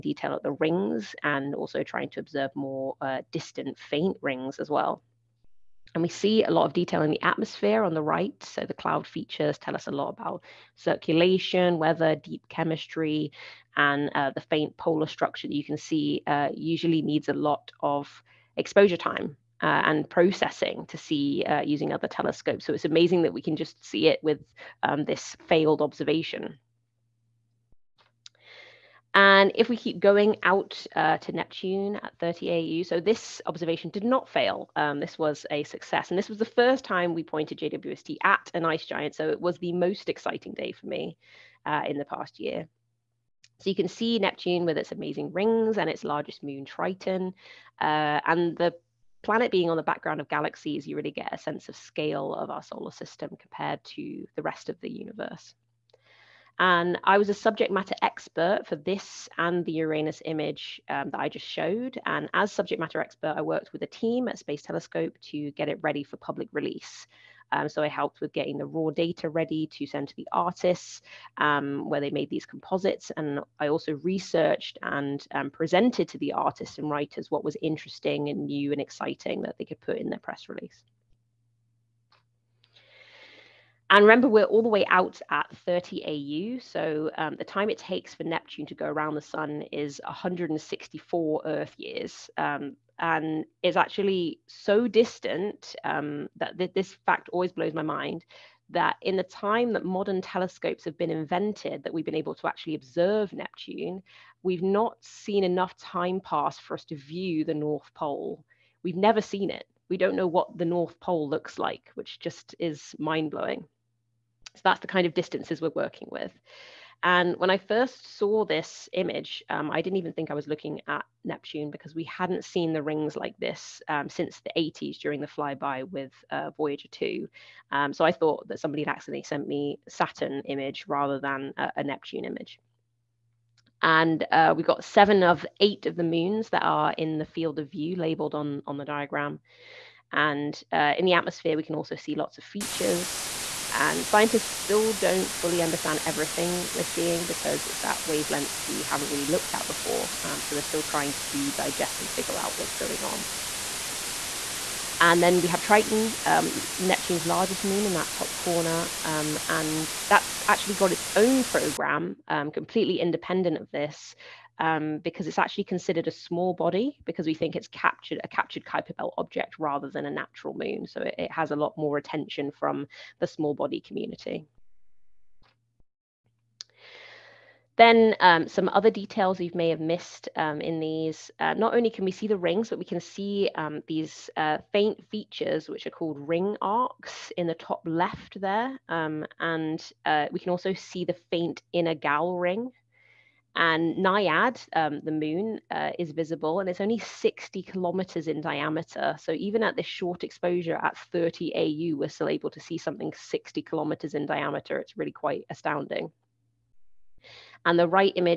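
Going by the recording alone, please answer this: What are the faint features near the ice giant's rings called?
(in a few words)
ring arcs.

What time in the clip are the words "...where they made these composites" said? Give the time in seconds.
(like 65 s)
71 s.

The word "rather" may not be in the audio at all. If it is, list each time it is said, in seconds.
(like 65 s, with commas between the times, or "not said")
130 s, 169 s.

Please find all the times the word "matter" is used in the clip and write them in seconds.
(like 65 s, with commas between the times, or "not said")
57 s, 62 s.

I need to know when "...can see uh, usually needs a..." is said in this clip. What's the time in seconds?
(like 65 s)
15 s.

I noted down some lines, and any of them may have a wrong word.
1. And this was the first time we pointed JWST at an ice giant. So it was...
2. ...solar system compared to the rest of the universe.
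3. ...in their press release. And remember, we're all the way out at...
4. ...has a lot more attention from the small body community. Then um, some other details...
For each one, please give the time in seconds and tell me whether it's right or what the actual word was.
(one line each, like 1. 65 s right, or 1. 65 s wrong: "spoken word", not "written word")
1. 36 s right
2. 52 s right
3. 79 s right
4. 171 s right.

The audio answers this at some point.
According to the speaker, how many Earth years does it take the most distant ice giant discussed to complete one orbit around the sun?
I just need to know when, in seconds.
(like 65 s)
90 s.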